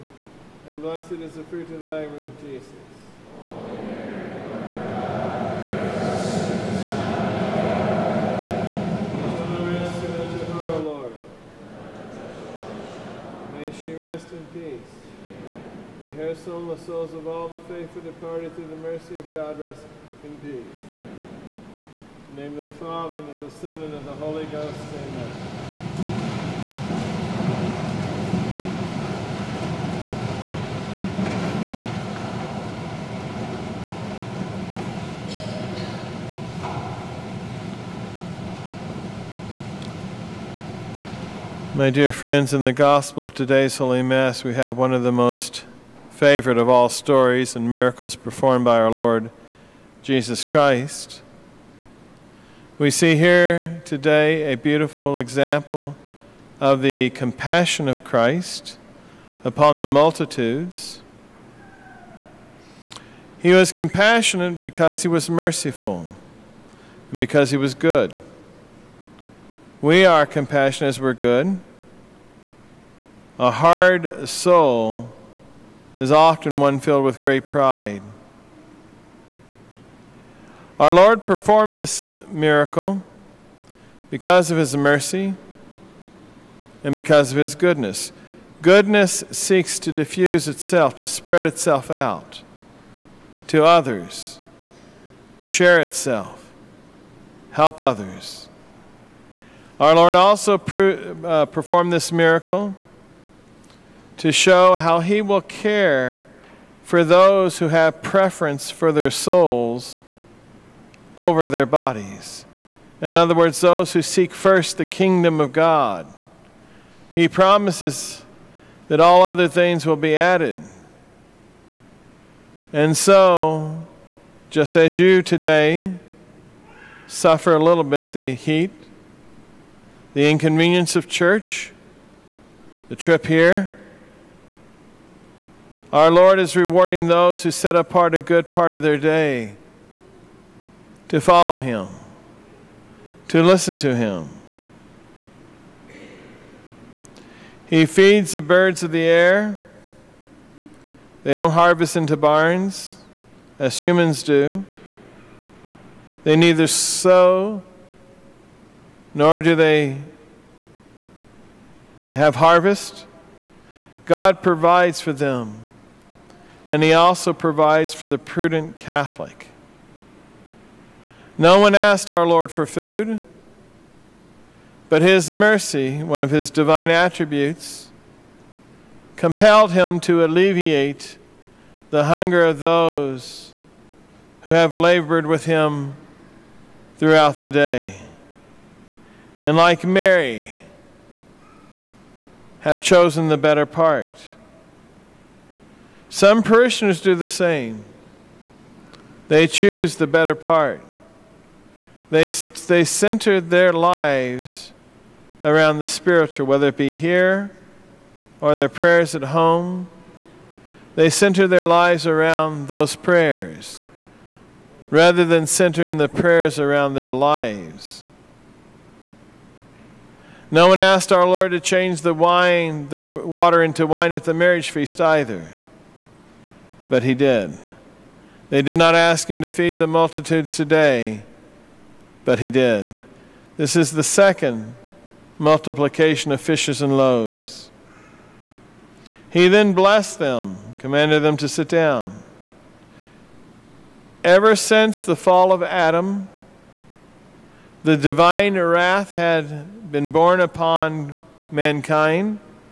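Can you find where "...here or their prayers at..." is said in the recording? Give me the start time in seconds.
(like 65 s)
206 s.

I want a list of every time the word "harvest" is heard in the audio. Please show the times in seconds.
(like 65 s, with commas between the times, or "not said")
151 s, 162 s.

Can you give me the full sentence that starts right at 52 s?
We see here today a beautiful example of the compassion of Christ upon the multitudes.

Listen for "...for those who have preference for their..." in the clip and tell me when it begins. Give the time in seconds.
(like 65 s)
106 s.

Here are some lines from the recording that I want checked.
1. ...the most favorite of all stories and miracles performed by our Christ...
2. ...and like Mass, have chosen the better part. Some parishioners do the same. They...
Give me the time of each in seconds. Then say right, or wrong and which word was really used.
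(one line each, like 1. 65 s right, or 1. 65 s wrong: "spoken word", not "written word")
1. 45 s wrong: "Lord", not "Christ"
2. 189 s wrong: "Mary", not "Mass".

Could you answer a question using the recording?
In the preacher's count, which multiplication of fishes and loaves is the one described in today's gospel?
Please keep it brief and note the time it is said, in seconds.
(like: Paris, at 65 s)
The second, at 234 s.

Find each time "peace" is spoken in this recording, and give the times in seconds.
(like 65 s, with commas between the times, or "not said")
14 s, 20 s.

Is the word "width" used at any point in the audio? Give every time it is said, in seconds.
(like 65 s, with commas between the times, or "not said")
not said.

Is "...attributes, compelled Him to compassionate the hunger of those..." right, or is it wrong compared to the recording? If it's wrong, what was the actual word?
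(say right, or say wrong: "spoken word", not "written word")
wrong: "alleviate", not "compassionate".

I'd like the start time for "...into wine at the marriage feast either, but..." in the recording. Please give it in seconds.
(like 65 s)
223 s.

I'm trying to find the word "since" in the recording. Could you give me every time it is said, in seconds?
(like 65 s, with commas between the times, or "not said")
244 s.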